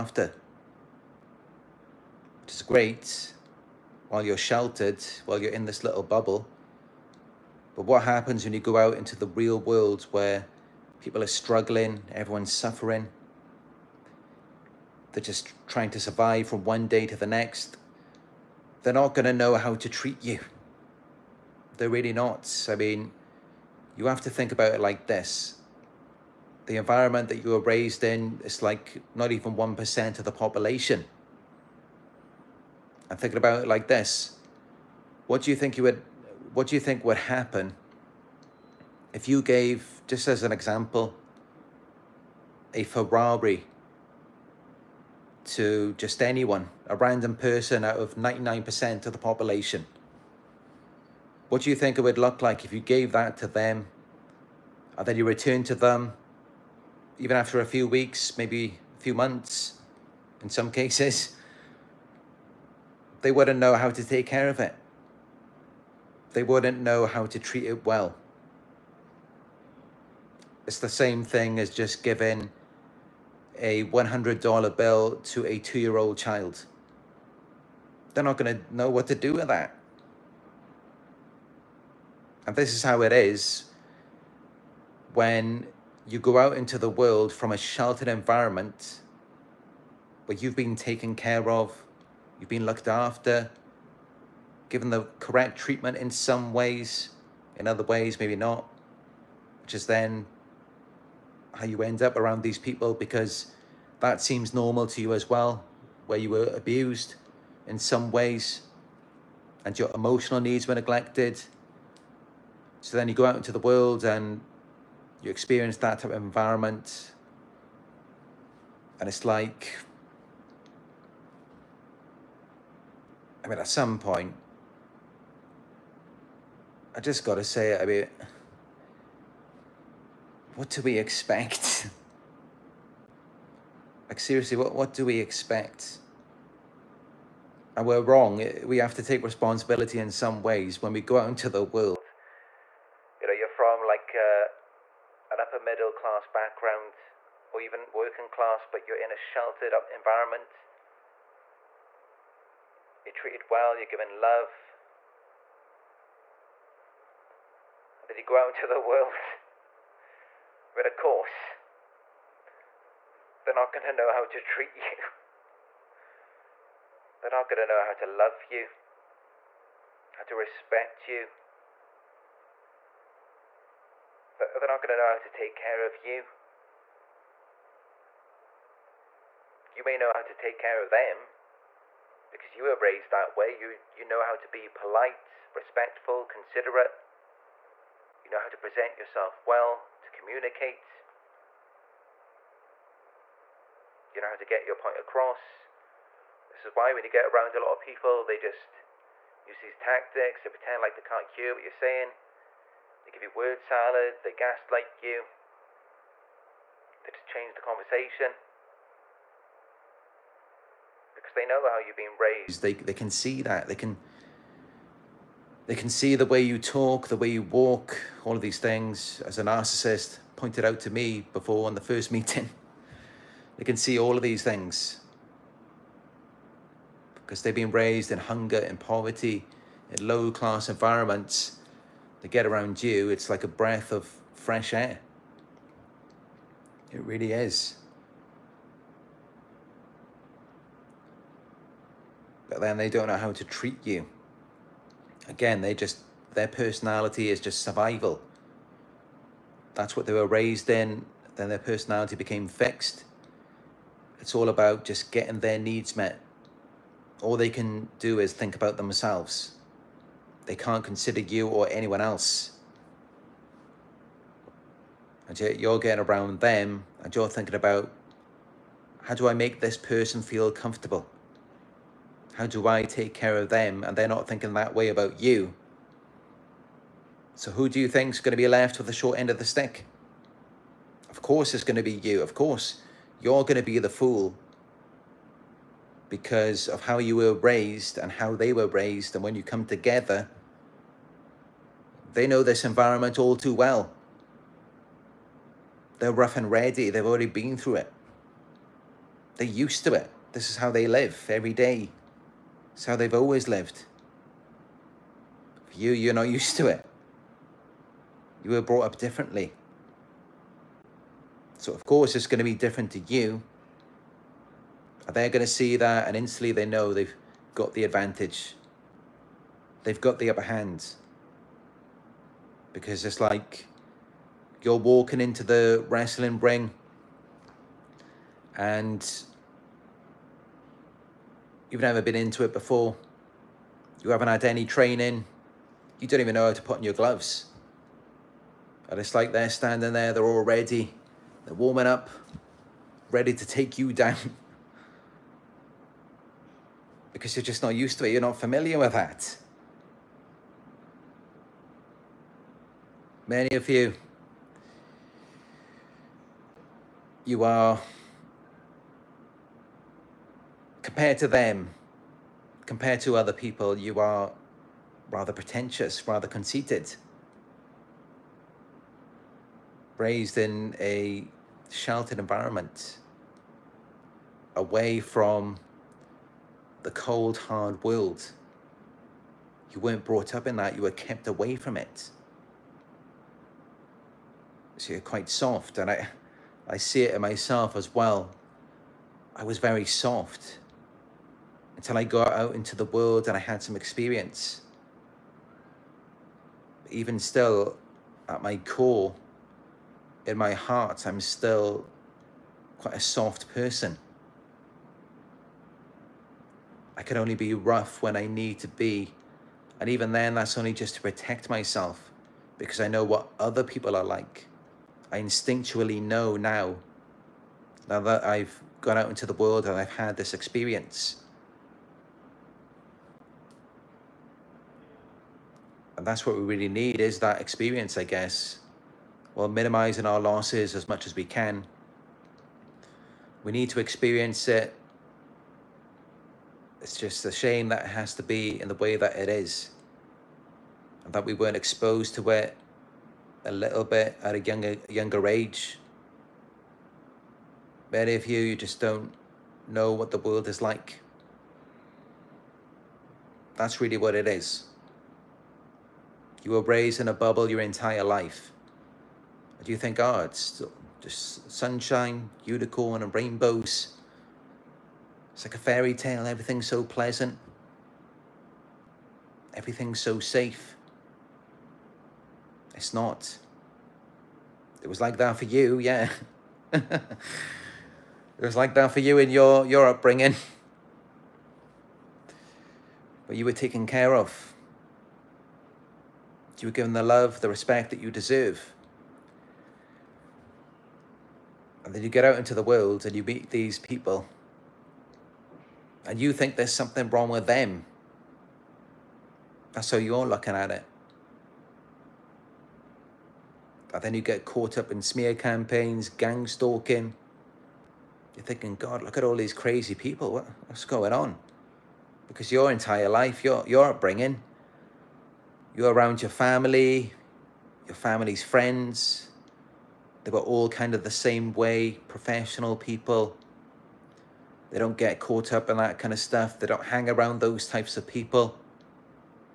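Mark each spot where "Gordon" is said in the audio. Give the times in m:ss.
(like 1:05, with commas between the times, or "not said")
not said.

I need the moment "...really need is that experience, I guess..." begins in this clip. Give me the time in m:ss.
7:06.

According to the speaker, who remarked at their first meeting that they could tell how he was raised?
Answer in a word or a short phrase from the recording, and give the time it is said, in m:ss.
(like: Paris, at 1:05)
a narcissist, at 3:39.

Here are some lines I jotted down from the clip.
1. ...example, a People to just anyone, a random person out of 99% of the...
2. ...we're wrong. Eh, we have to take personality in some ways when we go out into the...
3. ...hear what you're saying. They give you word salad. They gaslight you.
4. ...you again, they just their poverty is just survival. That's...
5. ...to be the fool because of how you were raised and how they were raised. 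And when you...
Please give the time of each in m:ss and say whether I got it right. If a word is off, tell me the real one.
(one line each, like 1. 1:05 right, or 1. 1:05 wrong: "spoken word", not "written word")
1. 0:40 wrong: "Ferrari", not "People"
2. 2:17 wrong: "responsibility", not "personality"
3. 3:21 right
4. 4:03 wrong: "personality", not "poverty"
5. 4:43 right.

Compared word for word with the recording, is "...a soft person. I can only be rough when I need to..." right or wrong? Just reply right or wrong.
right.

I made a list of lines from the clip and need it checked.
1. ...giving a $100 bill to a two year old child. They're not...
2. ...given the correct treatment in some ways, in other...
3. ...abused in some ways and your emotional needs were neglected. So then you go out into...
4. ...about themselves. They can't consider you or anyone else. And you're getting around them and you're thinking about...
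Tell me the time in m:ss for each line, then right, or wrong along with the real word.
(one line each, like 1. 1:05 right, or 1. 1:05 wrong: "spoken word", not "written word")
1. 1:12 right
2. 1:34 right
3. 1:46 right
4. 4:18 right.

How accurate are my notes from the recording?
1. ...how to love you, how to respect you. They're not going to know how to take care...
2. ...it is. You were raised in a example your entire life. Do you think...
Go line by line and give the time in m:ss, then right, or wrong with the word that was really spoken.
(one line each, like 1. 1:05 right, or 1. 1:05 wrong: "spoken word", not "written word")
1. 2:47 right
2. 7:34 wrong: "bubble", not "example".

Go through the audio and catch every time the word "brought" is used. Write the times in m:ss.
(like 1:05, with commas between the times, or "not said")
5:08, 6:20.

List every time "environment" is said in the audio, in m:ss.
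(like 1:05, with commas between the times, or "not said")
0:26, 1:28, 1:56, 2:29, 3:50, 4:52, 6:12.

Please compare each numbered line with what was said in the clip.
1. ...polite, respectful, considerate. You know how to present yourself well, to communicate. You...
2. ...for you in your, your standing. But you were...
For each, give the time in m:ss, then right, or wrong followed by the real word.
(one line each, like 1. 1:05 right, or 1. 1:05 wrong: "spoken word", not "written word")
1. 3:04 right
2. 7:58 wrong: "upbringing", not "standing".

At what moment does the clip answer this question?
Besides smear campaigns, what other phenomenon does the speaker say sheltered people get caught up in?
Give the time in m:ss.
8:26.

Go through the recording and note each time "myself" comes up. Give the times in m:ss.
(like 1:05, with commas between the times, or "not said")
6:27, 6:51.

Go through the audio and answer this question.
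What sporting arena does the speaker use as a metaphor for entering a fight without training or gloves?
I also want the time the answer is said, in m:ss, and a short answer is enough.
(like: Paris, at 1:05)
wrestling ring, at 5:25.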